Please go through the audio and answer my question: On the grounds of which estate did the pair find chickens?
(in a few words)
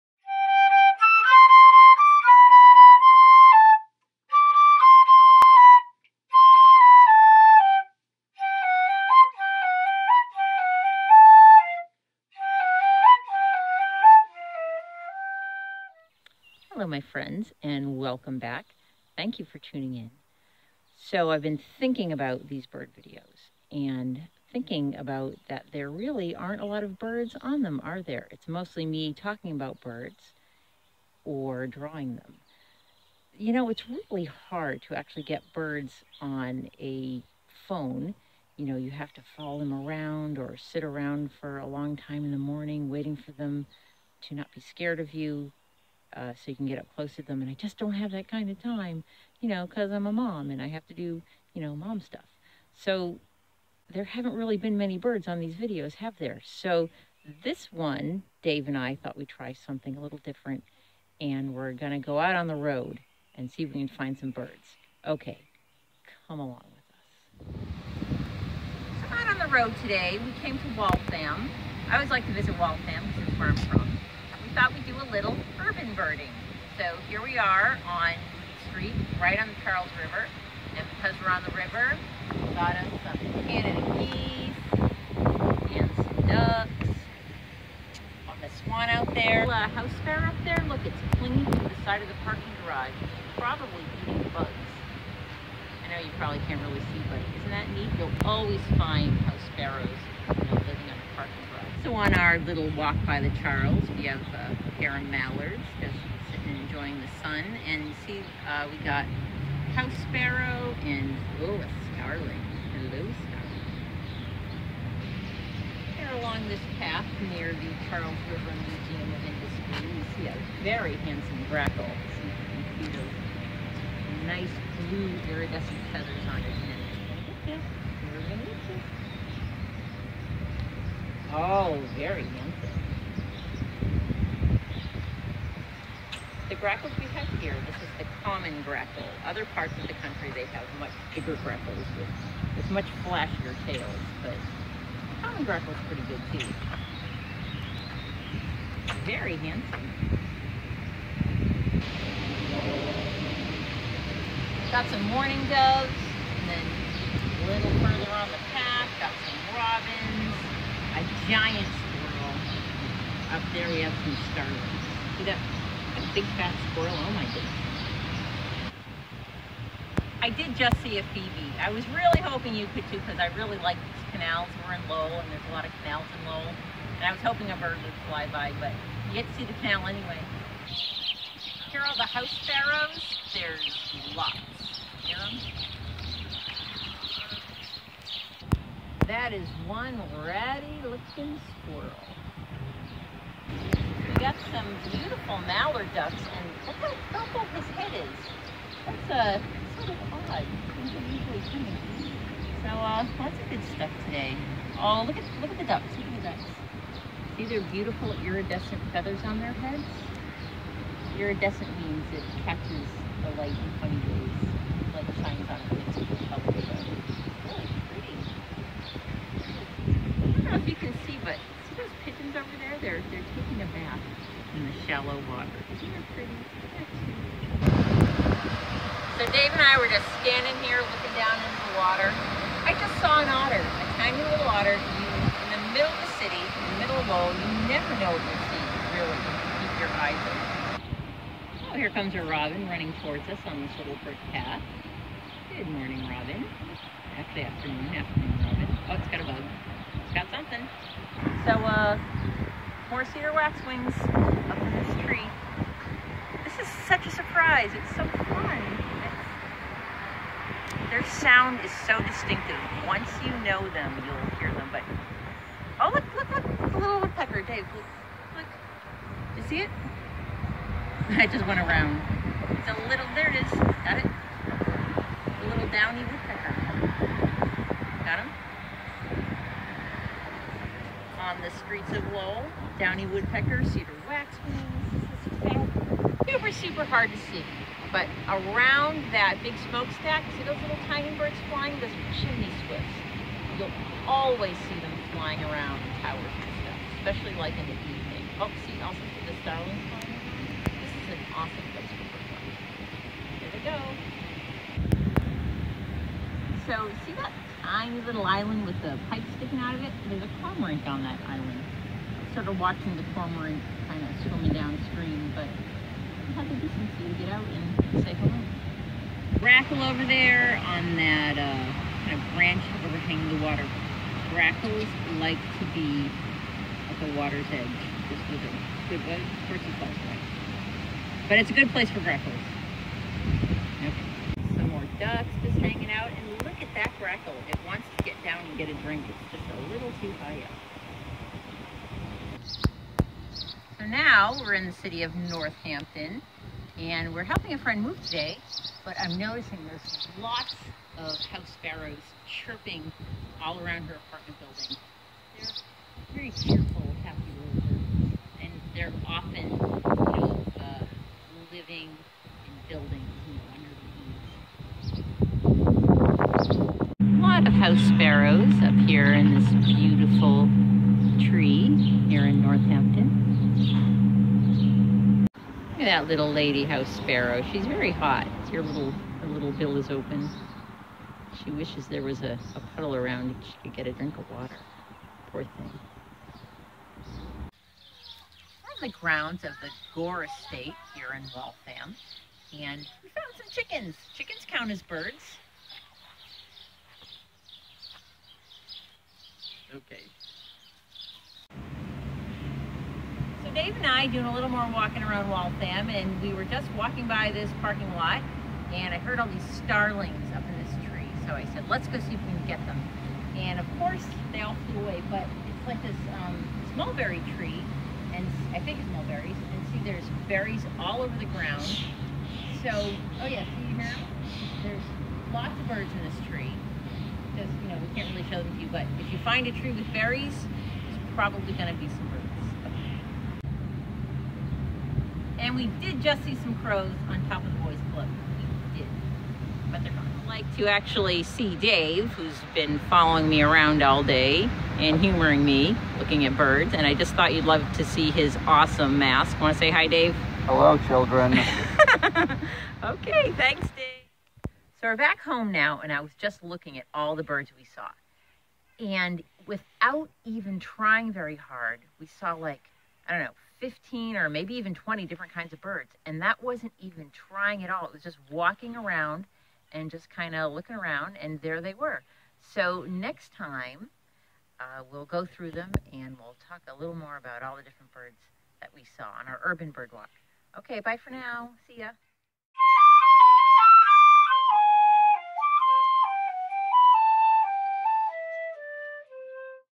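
Gore Estate.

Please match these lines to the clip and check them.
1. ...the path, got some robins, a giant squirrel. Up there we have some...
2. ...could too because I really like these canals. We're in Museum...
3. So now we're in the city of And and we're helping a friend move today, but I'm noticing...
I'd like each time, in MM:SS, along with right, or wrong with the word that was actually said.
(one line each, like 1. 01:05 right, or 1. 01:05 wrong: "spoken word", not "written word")
1. 02:38 right
2. 02:52 wrong: "Lowell", not "Museum"
3. 05:43 wrong: "Northampton", not "And".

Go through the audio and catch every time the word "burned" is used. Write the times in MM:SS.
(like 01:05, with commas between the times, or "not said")
not said.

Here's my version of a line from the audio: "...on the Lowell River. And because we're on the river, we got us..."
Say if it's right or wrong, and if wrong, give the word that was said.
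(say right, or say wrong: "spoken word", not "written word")
wrong: "Charles", not "Lowell".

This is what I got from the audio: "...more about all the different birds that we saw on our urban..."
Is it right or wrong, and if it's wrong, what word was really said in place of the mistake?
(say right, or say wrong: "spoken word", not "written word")
right.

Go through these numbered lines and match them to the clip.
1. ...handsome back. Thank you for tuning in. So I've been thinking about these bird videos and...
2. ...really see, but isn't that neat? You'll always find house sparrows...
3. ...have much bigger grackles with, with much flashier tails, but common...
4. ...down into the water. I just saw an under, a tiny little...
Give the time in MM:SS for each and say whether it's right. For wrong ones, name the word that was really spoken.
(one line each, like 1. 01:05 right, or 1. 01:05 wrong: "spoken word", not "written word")
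1. 00:17 wrong: "welcome", not "handsome"
2. 01:36 right
3. 02:20 right
4. 03:51 wrong: "otter", not "under".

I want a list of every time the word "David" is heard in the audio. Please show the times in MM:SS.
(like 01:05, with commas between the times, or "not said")
not said.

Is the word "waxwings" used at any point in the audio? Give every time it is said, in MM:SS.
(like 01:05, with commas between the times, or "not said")
04:13, 04:44.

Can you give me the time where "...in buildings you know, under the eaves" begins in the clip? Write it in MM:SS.
06:02.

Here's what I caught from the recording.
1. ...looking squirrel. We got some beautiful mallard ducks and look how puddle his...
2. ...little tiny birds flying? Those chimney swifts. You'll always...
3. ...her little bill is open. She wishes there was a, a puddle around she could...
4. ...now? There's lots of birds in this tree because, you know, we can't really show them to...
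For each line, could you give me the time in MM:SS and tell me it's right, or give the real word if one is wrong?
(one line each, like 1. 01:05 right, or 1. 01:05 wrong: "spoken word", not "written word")
1. 03:10 wrong: "purple", not "puddle"
2. 04:50 right
3. 06:18 right
4. 07:03 right.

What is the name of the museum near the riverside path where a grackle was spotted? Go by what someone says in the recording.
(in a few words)
Charles River Museum of Industry.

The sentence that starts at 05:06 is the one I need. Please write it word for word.
So, see that tiny little island with the pipe sticking out of it?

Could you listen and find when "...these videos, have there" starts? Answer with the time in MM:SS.
00:55.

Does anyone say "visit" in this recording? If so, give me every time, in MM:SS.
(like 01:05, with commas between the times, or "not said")
01:12.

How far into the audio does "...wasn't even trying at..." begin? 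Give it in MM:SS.
07:46.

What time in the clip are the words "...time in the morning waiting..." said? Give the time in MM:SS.
00:41.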